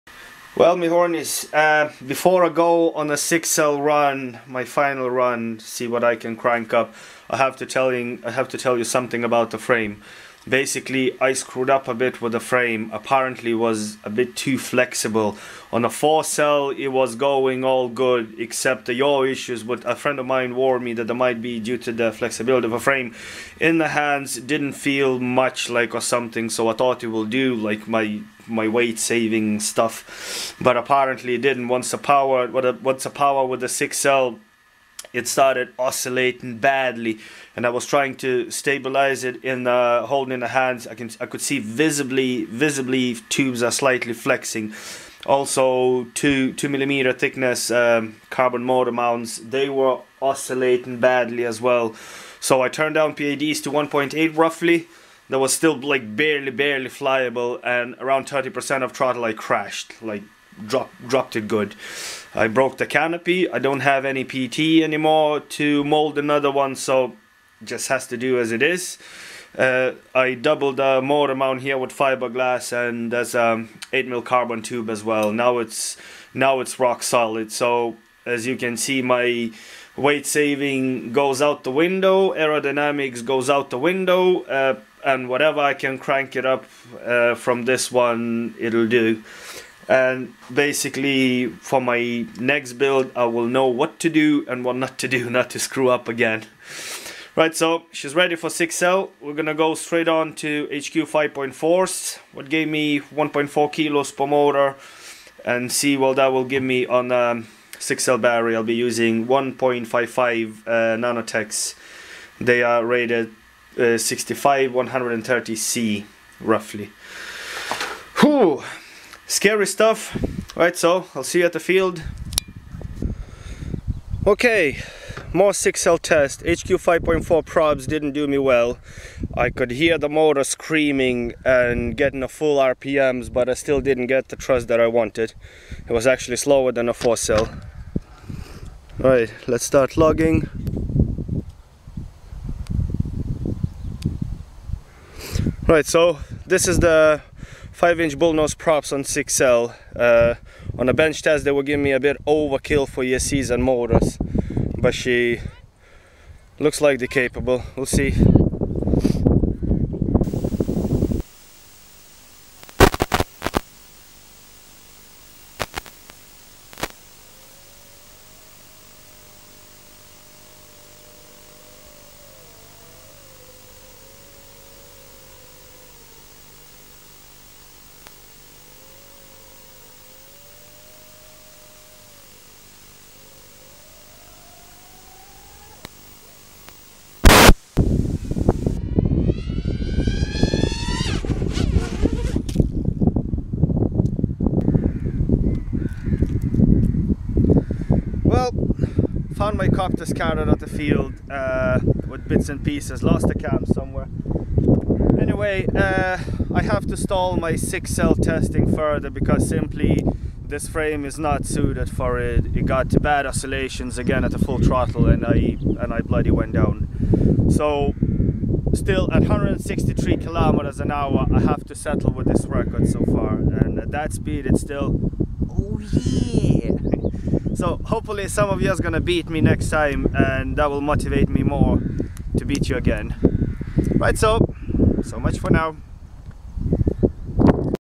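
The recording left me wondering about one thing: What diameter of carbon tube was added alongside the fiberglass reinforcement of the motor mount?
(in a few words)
8 mm.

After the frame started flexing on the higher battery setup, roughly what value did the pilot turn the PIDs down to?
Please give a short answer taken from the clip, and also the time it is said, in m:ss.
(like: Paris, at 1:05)
1.8, at 0:53.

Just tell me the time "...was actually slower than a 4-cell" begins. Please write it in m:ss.
2:15.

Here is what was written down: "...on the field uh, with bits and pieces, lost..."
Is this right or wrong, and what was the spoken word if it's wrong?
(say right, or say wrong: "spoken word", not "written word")
right.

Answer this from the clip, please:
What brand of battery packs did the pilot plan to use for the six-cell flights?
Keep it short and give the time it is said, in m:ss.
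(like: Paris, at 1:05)
Nano-tech, at 1:50.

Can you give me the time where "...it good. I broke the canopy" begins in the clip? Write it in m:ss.
1:01.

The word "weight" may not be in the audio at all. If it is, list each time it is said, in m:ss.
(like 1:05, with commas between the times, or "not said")
0:28, 1:19.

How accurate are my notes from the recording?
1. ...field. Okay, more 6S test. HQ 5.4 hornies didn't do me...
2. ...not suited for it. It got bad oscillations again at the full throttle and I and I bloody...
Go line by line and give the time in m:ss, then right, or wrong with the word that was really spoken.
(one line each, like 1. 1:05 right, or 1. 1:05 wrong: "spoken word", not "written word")
1. 2:01 wrong: "probes", not "hornies"
2. 3:31 right.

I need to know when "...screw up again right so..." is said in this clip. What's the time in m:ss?
1:35.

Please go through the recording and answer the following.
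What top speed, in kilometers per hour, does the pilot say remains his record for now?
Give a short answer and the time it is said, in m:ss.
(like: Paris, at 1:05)
163, at 3:39.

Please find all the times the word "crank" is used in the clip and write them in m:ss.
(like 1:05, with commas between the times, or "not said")
0:06, 1:25.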